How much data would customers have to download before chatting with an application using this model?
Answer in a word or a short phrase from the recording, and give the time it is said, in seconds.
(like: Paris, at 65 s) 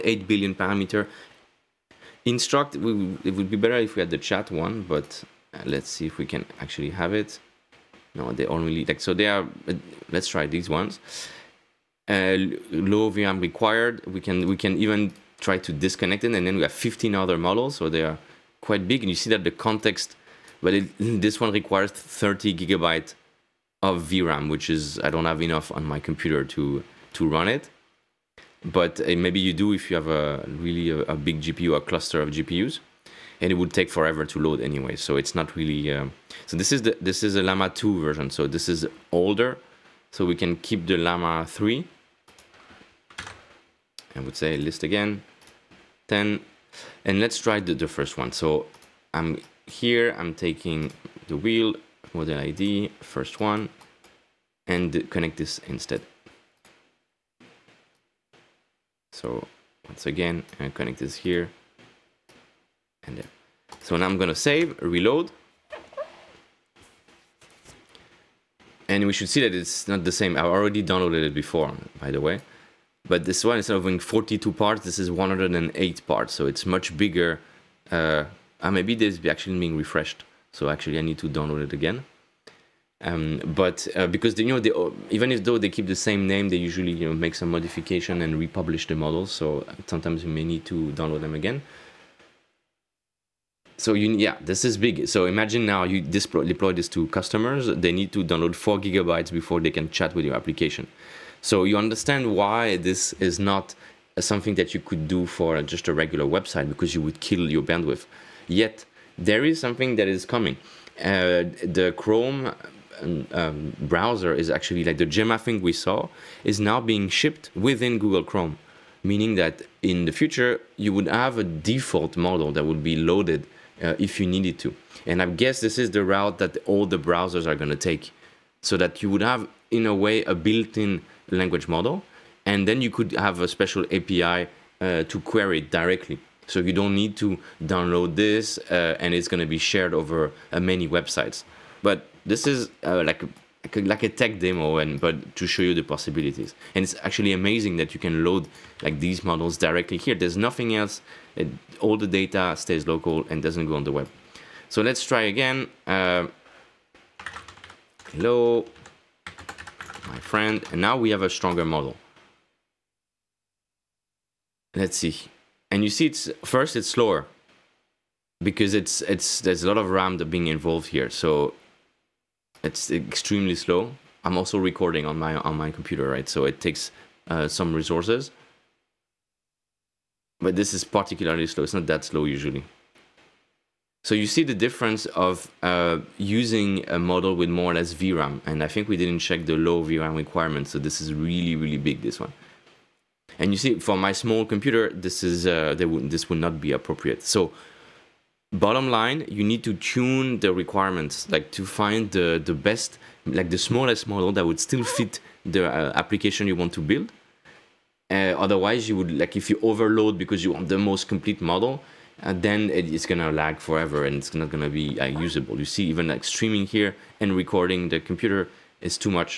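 4 gigabytes, at 98 s.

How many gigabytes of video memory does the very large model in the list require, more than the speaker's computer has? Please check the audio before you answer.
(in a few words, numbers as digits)
30.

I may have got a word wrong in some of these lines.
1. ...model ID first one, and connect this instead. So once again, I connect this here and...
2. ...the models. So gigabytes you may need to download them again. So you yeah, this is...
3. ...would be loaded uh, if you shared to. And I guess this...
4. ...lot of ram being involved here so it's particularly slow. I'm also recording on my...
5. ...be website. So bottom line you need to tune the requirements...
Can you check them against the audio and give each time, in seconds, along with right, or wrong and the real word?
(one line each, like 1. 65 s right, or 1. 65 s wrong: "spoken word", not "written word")
1. 52 s right
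2. 88 s wrong: "sometimes", not "gigabytes"
3. 122 s wrong: "needed", not "shared"
4. 169 s wrong: "extremely", not "particularly"
5. 196 s wrong: "appropriate", not "website".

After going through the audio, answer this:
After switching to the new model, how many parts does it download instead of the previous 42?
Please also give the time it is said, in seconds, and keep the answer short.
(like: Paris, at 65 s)
108, at 75 s.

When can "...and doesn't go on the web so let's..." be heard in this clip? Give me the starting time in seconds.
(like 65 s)
153 s.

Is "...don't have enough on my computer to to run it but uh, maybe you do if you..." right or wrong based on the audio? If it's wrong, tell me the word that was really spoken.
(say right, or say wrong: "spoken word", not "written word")
right.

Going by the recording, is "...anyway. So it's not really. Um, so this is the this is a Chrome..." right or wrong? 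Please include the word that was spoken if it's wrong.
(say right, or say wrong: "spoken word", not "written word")
wrong: "Llama", not "Chrome".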